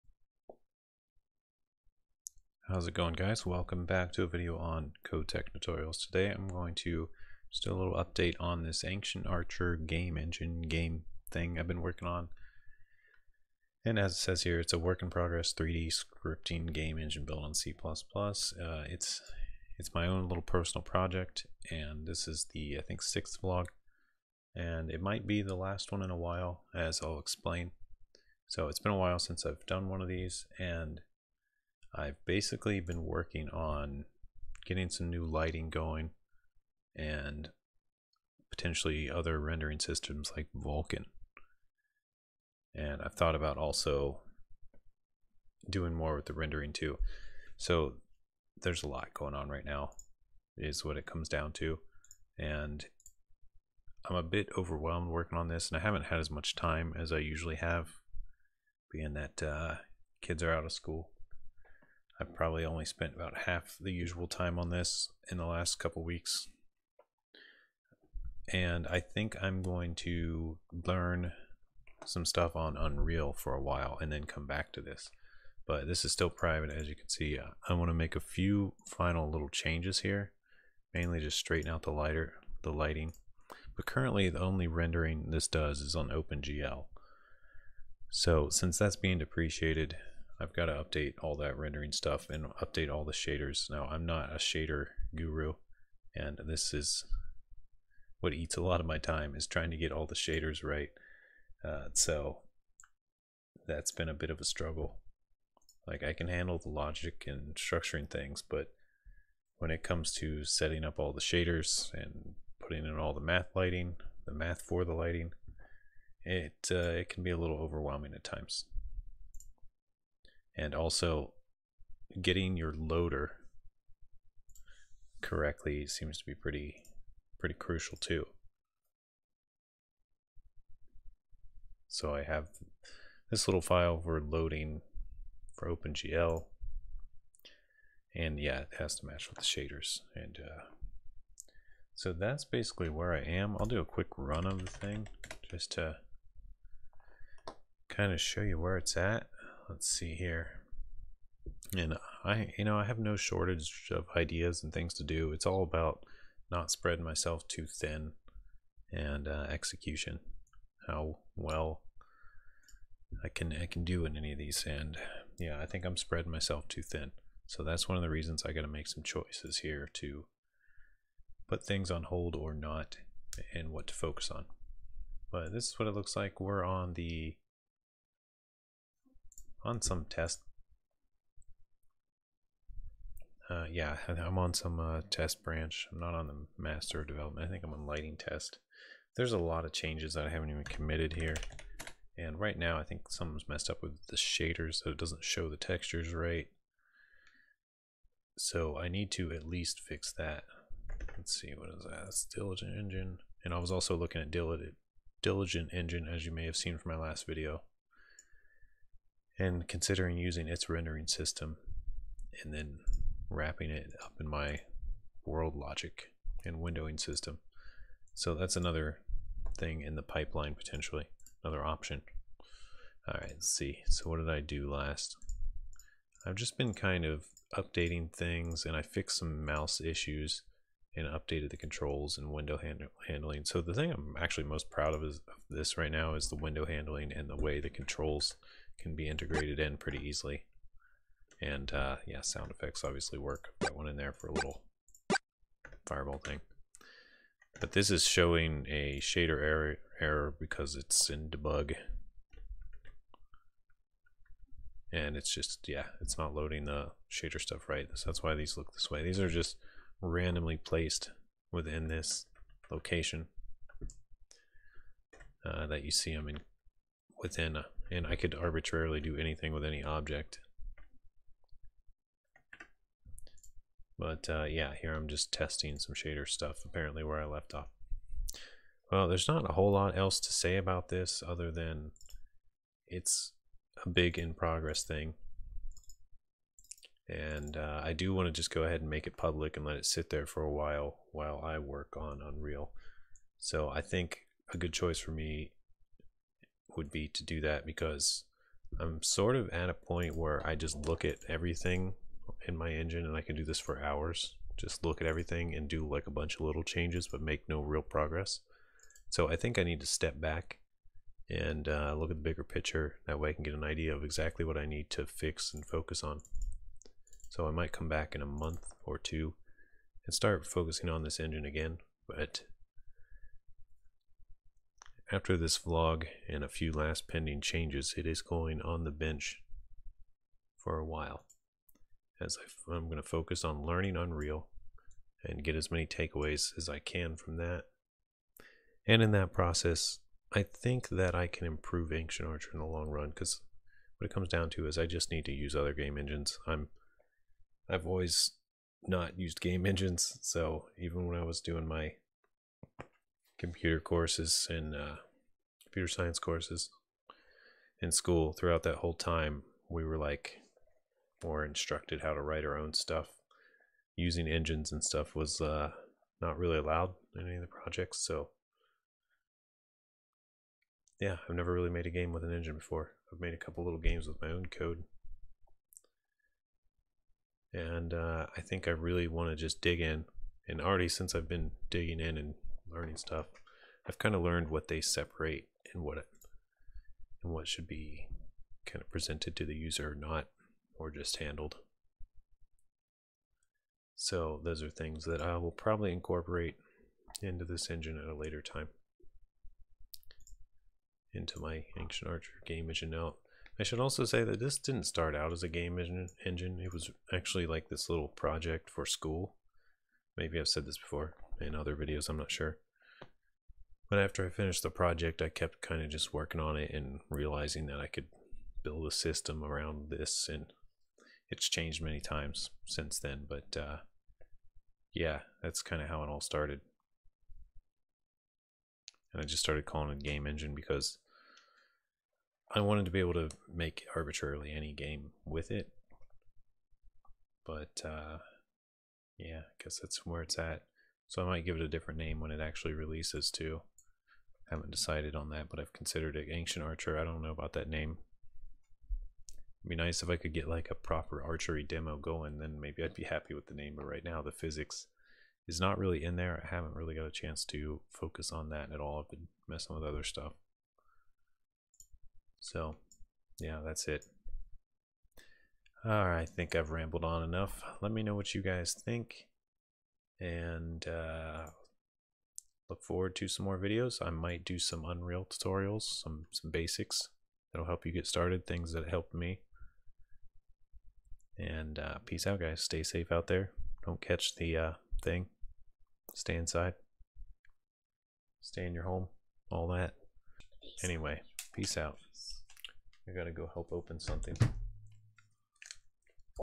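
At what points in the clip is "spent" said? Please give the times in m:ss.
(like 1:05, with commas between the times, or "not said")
1:02.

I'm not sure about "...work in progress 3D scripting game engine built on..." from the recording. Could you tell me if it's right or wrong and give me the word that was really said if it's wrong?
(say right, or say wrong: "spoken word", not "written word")
right.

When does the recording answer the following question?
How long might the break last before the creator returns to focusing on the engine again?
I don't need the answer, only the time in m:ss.
5:18.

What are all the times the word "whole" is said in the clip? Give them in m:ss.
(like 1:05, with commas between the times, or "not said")
4:39, 5:58.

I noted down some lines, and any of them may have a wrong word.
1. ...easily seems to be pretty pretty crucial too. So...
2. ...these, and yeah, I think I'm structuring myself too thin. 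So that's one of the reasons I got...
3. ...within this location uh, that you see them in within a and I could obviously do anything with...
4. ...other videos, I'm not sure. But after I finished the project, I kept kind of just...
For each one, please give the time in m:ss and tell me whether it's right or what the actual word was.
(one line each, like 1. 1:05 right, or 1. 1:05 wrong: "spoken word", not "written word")
1. 2:05 wrong: "correctly", not "easily"
2. 2:44 wrong: "spreading", not "structuring"
3. 4:21 wrong: "arbitrarily", not "obviously"
4. 6:51 right.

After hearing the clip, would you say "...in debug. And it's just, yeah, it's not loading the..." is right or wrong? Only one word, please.
right.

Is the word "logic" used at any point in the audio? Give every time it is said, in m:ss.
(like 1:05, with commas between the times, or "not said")
1:46, 3:35.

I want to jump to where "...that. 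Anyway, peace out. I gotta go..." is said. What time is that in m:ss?
8:09.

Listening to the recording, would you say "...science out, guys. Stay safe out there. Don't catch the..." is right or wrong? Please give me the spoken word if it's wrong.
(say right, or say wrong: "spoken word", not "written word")
wrong: "peace", not "science".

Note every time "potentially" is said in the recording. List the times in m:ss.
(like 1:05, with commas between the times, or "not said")
0:38, 3:40.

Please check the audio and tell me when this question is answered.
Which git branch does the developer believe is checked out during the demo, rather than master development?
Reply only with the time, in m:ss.
3:07.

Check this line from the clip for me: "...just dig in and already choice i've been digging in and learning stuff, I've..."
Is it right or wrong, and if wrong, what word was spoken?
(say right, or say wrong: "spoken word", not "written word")
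wrong: "since", not "choice".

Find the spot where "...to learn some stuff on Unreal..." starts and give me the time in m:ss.
1:09.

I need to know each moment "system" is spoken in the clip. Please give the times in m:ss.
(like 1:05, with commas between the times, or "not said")
0:39, 3:31, 3:36, 6:58.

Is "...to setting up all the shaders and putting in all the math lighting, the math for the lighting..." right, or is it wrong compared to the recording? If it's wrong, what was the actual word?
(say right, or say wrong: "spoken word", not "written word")
right.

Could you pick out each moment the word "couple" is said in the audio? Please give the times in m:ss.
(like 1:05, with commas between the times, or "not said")
1:05, 6:13.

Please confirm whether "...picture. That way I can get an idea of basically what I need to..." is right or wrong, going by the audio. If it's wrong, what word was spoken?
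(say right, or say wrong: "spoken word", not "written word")
wrong: "exactly", not "basically".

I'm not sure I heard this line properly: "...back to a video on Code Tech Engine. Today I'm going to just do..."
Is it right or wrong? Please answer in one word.
wrong.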